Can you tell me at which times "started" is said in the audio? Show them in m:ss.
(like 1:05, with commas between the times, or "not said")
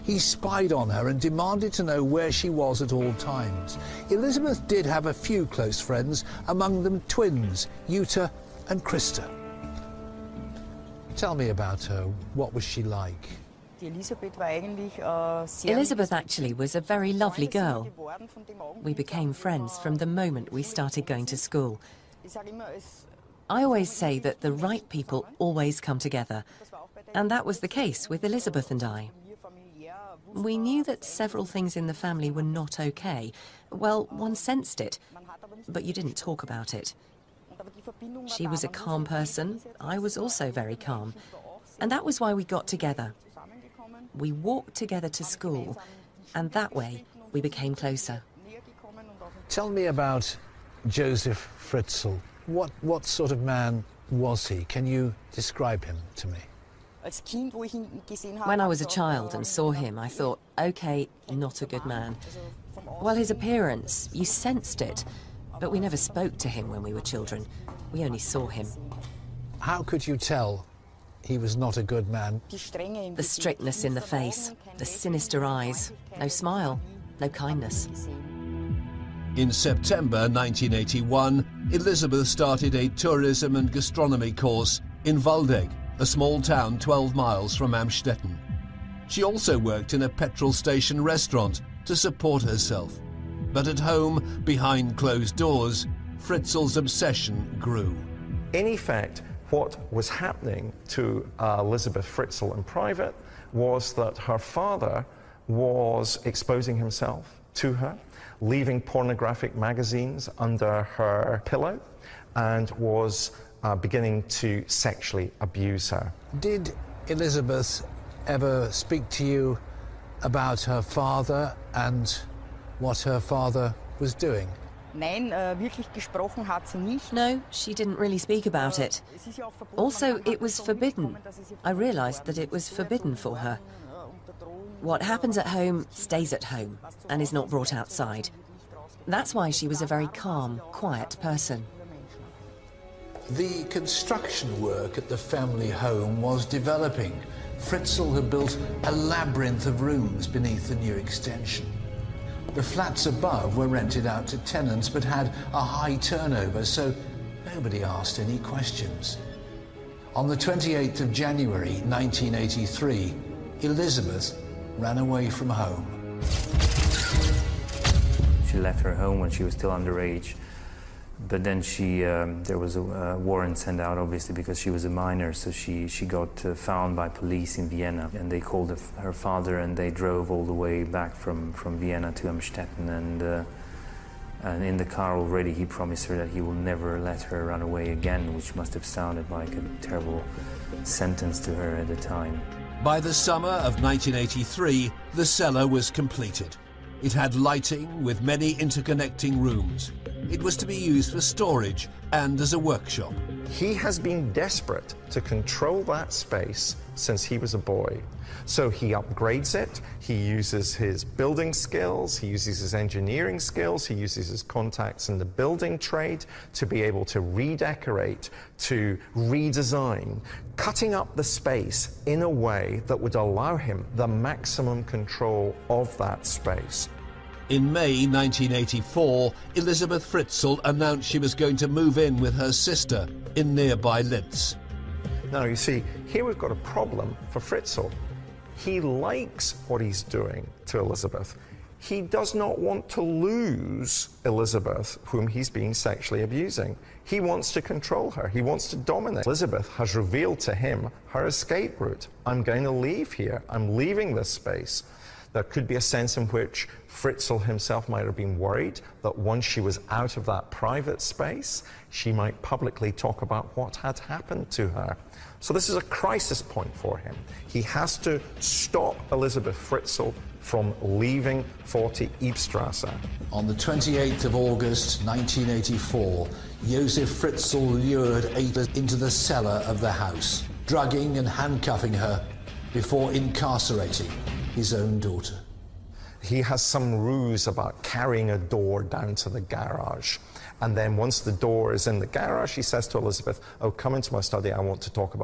0:20, 1:22.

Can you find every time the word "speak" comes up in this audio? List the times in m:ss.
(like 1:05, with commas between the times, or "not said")
1:58, 2:08.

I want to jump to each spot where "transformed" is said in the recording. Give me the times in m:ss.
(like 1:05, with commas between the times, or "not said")
not said.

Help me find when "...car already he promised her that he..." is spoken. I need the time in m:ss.
3:04.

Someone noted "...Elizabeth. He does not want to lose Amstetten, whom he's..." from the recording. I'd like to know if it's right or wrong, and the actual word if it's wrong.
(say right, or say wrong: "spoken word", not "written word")
wrong: "Elizabeth", not "Amstetten".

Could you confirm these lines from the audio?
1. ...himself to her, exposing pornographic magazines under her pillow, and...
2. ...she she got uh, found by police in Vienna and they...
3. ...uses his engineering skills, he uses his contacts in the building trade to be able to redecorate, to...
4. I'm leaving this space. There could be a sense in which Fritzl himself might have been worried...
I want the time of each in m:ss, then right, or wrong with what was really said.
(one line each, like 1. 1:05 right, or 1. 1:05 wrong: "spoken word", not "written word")
1. 1:46 wrong: "leaving", not "exposing"
2. 2:55 right
3. 3:32 right
4. 4:13 right.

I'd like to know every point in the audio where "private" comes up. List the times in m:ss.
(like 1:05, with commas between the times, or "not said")
1:42, 4:20.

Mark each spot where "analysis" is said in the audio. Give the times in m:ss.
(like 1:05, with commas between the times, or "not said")
not said.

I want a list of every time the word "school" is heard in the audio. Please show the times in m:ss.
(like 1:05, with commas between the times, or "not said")
0:21, 0:45.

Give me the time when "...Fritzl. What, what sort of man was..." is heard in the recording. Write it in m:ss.
0:51.